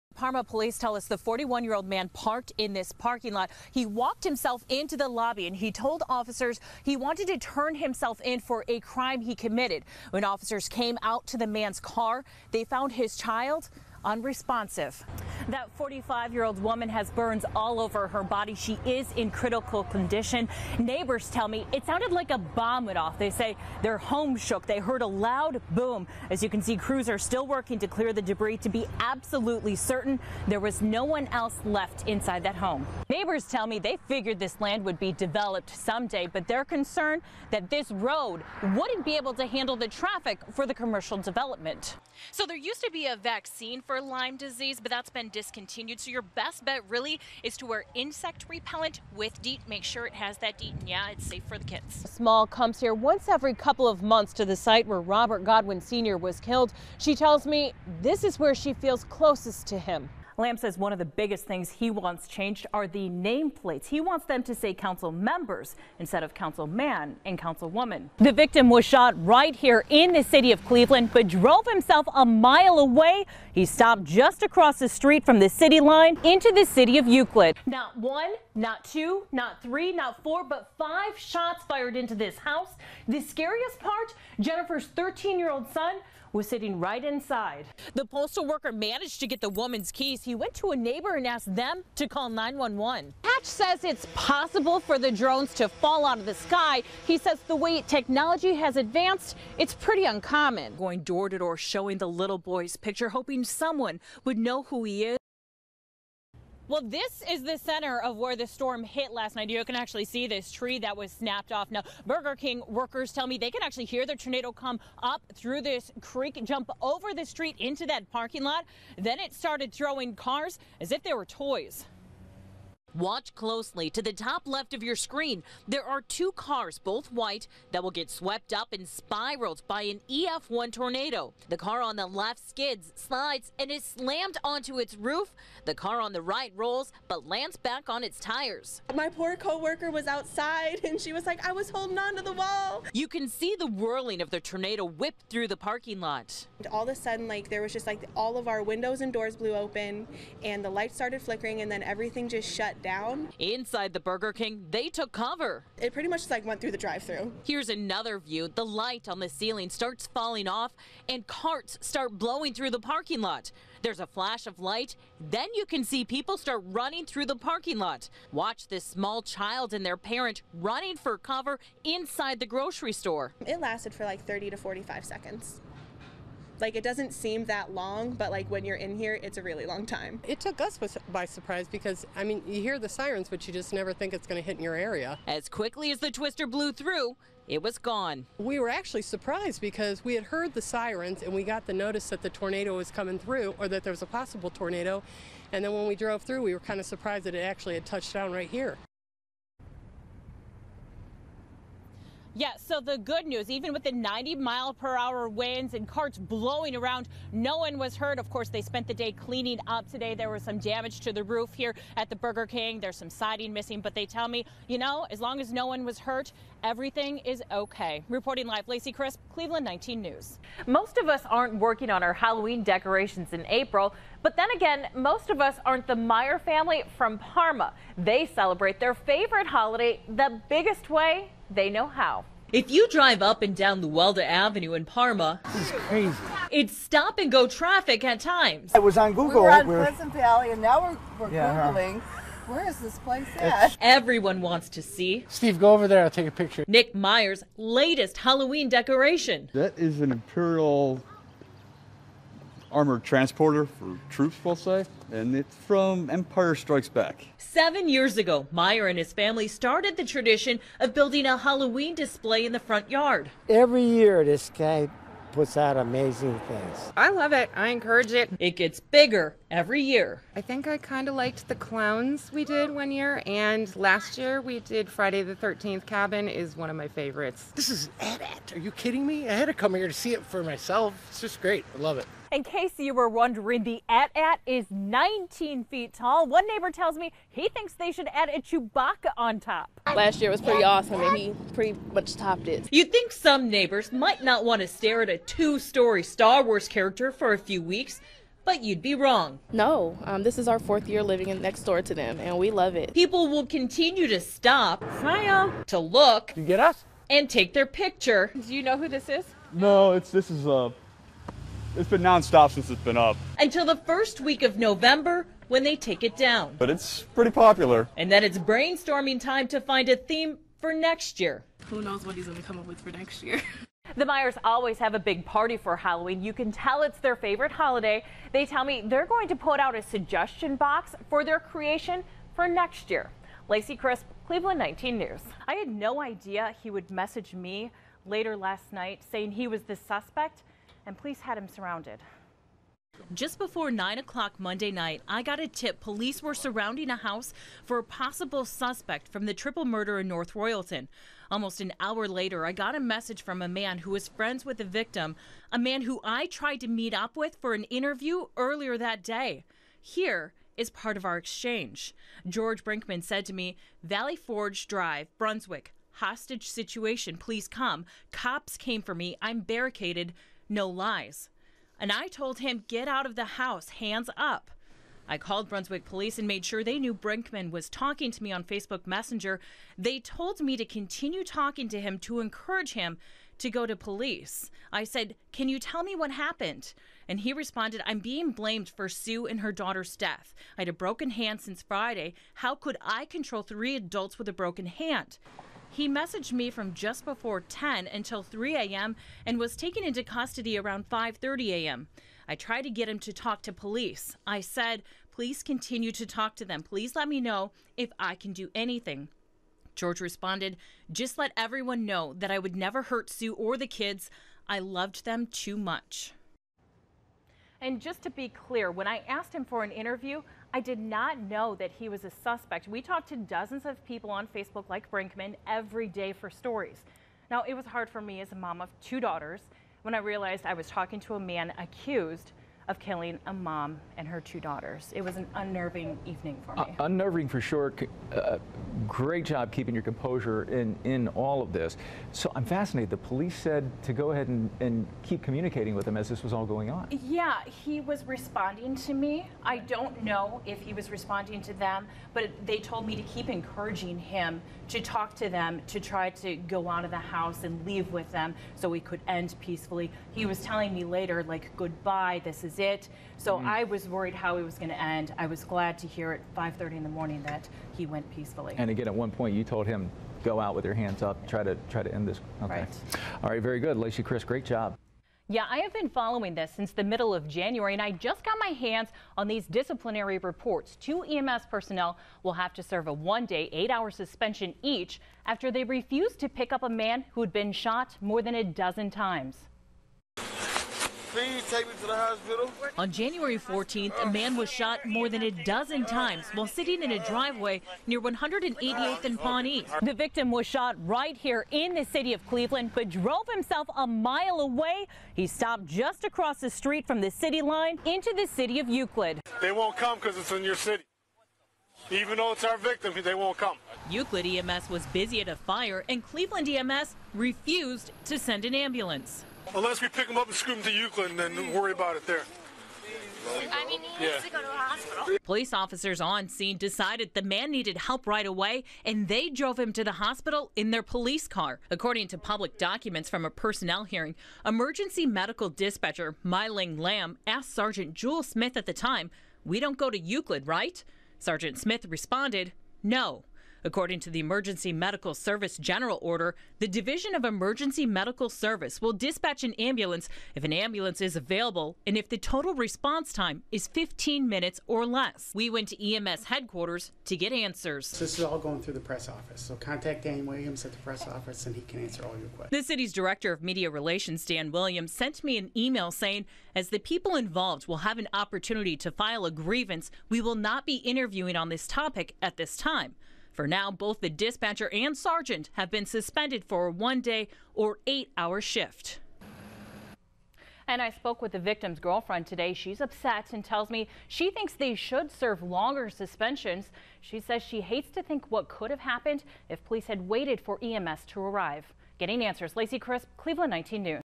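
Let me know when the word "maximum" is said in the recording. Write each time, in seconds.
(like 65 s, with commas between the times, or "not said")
not said.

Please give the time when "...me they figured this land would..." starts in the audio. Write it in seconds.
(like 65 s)
33 s.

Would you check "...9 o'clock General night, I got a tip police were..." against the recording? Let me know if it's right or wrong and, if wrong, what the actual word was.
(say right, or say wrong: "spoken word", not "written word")
wrong: "Monday", not "General".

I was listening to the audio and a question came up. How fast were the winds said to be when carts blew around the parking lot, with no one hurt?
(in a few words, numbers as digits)
90 mph.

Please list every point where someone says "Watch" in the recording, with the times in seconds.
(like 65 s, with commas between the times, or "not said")
122 s, 168 s.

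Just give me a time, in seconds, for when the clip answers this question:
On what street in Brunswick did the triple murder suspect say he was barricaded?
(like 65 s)
363 s.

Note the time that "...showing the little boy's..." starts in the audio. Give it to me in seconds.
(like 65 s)
101 s.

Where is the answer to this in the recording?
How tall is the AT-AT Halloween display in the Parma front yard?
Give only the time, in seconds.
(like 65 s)
284 s.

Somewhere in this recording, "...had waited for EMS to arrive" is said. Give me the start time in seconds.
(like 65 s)
589 s.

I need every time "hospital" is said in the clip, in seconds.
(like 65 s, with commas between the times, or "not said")
491 s, 524 s, 529 s.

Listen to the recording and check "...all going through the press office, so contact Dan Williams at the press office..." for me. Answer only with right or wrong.
right.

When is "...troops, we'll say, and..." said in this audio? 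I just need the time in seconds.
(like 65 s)
254 s.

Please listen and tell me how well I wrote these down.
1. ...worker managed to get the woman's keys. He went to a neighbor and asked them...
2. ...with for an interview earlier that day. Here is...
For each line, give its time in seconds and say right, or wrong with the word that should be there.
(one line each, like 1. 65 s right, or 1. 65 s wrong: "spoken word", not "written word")
1. 88 s right
2. 357 s right.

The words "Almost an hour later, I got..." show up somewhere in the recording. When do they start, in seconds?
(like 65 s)
351 s.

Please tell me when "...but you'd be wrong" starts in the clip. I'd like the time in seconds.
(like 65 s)
298 s.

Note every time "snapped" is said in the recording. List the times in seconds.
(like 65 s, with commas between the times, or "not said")
111 s.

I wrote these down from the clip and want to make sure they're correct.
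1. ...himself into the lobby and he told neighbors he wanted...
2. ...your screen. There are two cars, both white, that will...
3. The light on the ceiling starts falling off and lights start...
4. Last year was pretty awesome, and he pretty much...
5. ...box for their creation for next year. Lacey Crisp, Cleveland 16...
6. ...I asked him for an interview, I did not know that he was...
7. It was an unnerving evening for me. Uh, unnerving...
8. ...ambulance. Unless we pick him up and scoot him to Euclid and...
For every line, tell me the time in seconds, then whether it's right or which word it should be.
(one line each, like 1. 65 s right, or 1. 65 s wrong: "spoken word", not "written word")
1. 4 s wrong: "officers", not "neighbors"
2. 124 s right
3. 158 s wrong: "carts", not "lights"
4. 289 s right
5. 330 s wrong: "19", not "16"
6. 418 s right
7. 434 s right
8. 518 s right.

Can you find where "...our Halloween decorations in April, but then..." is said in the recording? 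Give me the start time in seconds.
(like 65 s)
222 s.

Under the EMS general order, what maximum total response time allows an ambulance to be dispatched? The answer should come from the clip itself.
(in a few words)
15 minutes.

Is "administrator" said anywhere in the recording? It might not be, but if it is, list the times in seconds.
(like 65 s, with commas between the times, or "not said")
not said.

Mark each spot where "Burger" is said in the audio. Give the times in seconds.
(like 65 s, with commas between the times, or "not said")
112 s, 153 s, 212 s.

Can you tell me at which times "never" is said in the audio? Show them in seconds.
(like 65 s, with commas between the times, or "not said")
183 s, 412 s.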